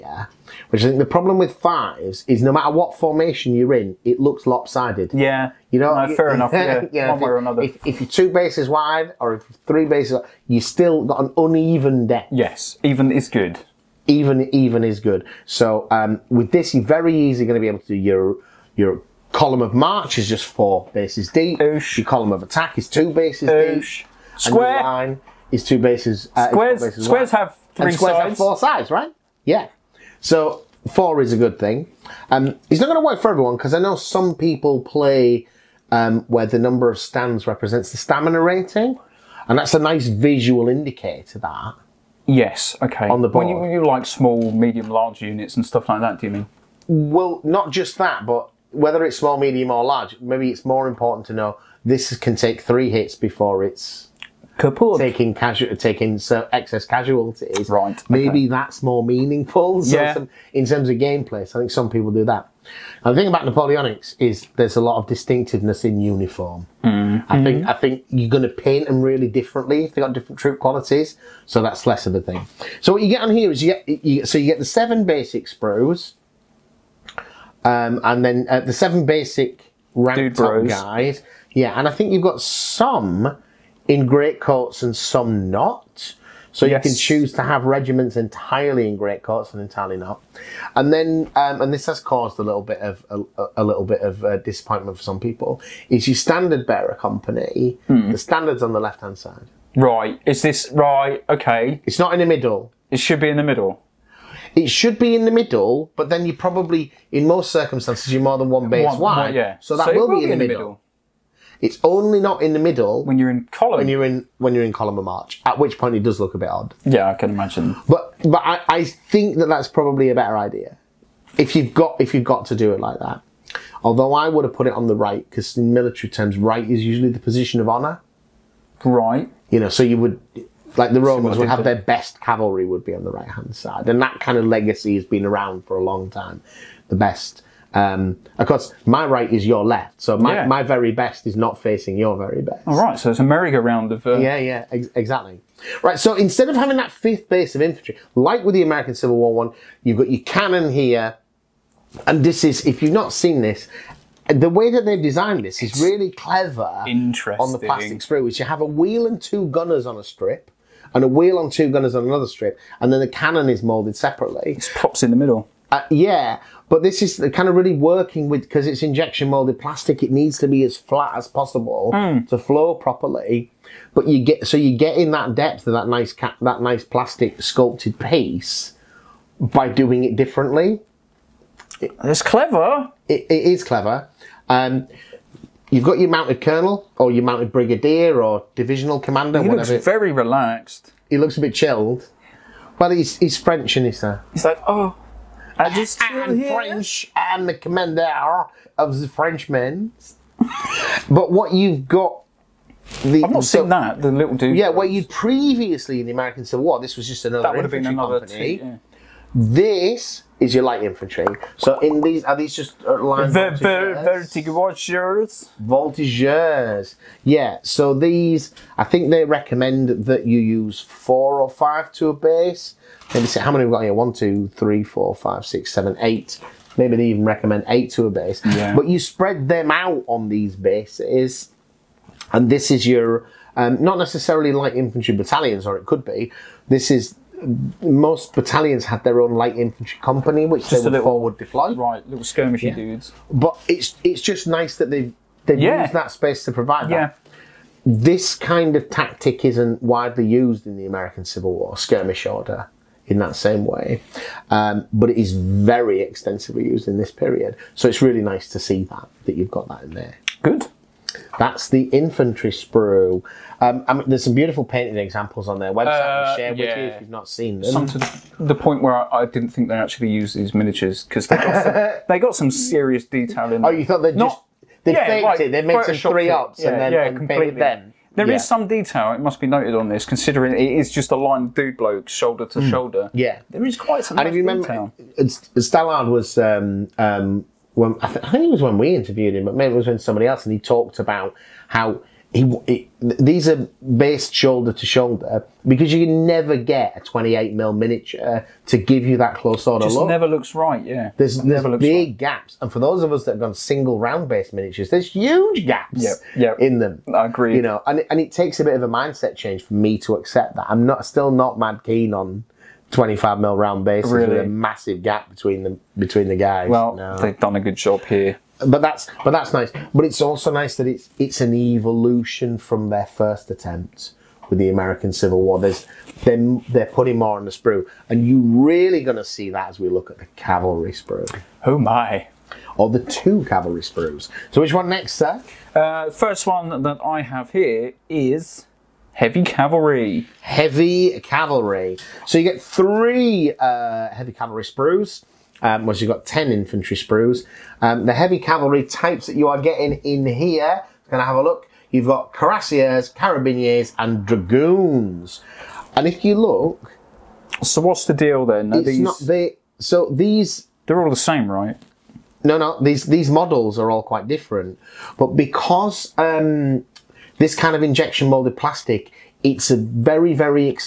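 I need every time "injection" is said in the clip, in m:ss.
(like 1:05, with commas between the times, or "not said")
2:48, 6:07.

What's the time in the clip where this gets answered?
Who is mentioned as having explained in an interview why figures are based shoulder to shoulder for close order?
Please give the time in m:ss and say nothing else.
4:45.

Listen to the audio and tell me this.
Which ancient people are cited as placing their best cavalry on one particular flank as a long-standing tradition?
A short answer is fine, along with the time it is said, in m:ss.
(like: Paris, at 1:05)
The Romans, at 2:11.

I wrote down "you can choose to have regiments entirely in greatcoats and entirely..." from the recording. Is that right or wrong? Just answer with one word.
right.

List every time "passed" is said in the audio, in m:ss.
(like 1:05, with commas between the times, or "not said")
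not said.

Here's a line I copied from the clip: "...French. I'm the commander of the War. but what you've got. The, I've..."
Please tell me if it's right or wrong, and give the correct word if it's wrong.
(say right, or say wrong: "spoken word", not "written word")
wrong: "Frenchmen", not "War".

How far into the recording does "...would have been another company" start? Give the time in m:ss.
3:27.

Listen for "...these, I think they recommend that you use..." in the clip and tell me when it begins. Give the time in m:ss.
3:37.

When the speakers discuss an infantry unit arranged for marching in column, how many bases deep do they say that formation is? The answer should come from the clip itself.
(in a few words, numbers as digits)
4.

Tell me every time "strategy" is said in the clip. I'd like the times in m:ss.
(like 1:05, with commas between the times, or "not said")
not said.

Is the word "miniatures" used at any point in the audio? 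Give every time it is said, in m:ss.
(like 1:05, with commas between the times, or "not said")
4:30, 4:57, 5:04.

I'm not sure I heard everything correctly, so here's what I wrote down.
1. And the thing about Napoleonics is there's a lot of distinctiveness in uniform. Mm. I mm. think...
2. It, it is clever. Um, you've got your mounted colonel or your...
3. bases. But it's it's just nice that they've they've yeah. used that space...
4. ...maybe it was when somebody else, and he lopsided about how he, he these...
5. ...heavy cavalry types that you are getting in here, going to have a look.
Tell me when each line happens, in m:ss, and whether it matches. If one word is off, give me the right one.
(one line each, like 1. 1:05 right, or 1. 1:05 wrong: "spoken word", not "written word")
1. 1:03 right
2. 3:03 right
3. 4:02 wrong: "dudes", not "bases"
4. 4:49 wrong: "talked", not "lopsided"
5. 5:48 right.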